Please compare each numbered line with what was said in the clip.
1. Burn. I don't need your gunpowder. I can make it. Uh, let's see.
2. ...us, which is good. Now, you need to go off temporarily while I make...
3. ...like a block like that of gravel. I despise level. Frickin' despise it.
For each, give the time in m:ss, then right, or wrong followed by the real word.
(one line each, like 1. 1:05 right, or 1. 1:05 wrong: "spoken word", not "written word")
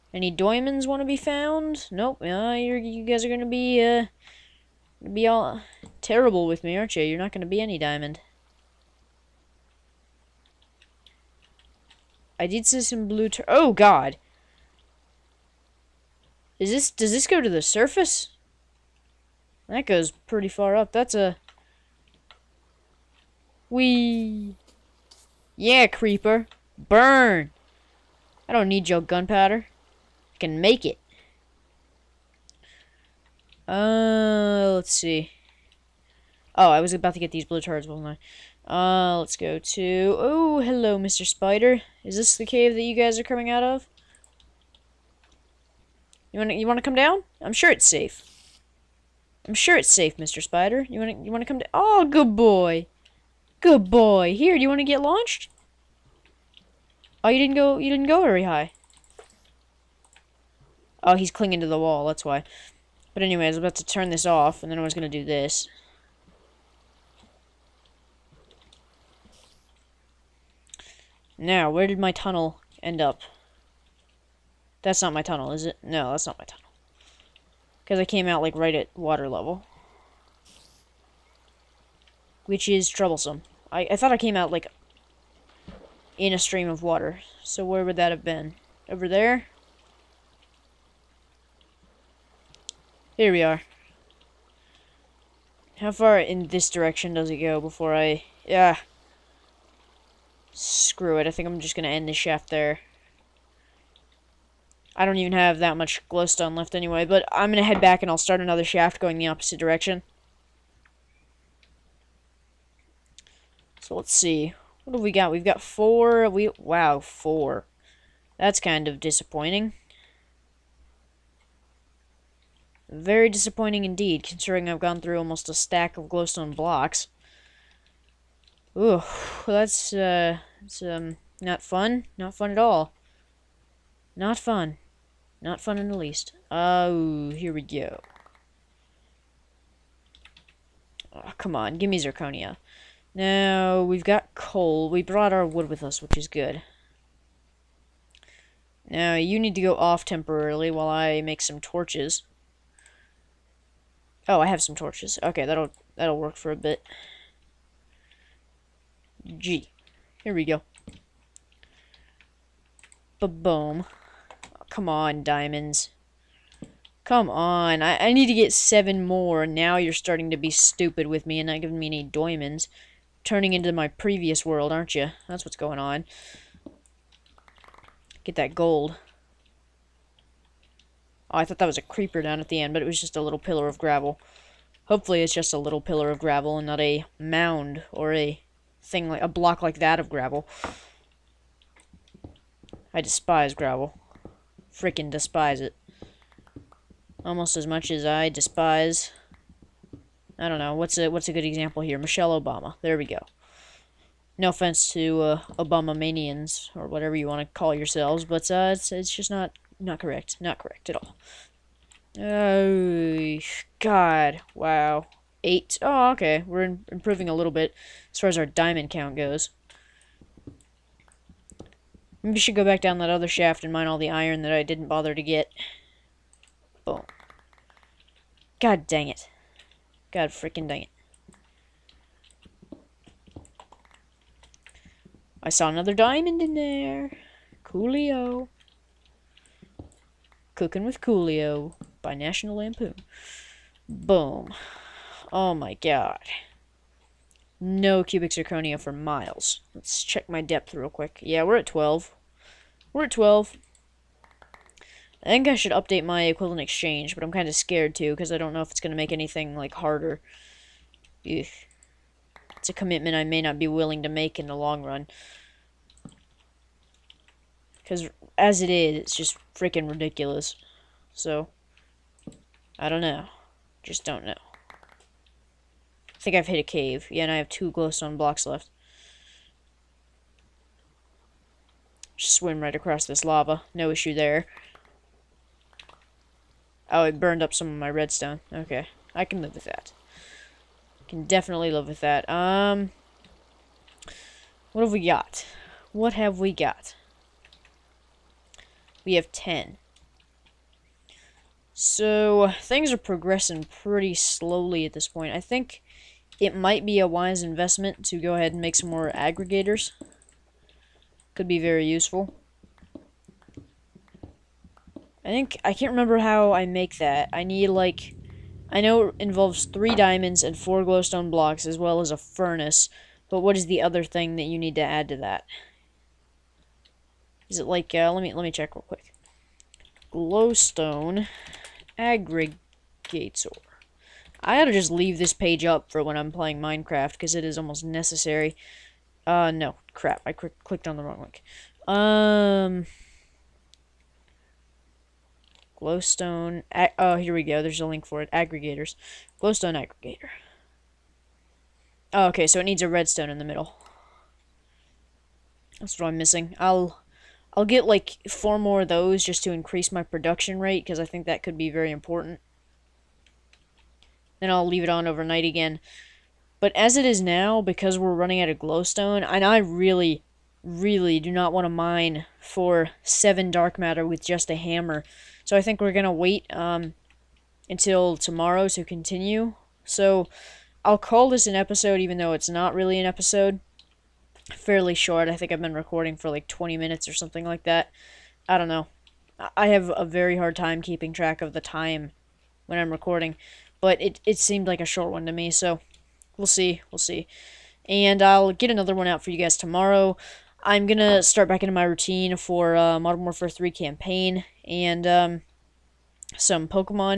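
1. 0:26 right
2. 2:25 right
3. 3:09 wrong: "gravel", not "level".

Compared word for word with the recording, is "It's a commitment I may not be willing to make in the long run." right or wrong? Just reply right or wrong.
right.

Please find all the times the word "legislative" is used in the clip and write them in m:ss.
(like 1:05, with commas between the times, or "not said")
not said.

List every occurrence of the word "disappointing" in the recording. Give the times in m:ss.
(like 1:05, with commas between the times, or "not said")
1:58, 2:03.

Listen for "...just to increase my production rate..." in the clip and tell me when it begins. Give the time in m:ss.
5:59.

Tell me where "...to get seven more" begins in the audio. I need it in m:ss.
2:48.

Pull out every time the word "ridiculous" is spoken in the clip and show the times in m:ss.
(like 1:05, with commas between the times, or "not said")
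4:29.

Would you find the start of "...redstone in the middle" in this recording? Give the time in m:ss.
5:52.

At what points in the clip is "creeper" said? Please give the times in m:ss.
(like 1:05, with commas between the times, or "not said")
0:25, 3:01.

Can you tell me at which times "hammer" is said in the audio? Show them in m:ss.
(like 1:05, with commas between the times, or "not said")
6:14.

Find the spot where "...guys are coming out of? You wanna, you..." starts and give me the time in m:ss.
0:42.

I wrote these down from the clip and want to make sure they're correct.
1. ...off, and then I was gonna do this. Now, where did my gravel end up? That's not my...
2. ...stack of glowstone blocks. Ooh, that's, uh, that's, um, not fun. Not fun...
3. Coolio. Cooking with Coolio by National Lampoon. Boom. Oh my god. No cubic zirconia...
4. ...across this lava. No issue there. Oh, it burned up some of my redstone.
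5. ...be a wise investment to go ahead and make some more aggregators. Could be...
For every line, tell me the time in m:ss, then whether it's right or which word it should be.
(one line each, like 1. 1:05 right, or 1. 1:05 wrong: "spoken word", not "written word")
1. 1:04 wrong: "tunnel", not "gravel"
2. 2:05 right
3. 3:57 right
4. 4:42 right
5. 5:06 right.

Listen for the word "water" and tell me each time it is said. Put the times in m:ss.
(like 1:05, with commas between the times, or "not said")
1:18, 1:26.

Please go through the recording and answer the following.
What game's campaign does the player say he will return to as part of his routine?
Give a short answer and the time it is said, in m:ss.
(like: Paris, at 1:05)
Modern Warfare 3, at 6:42.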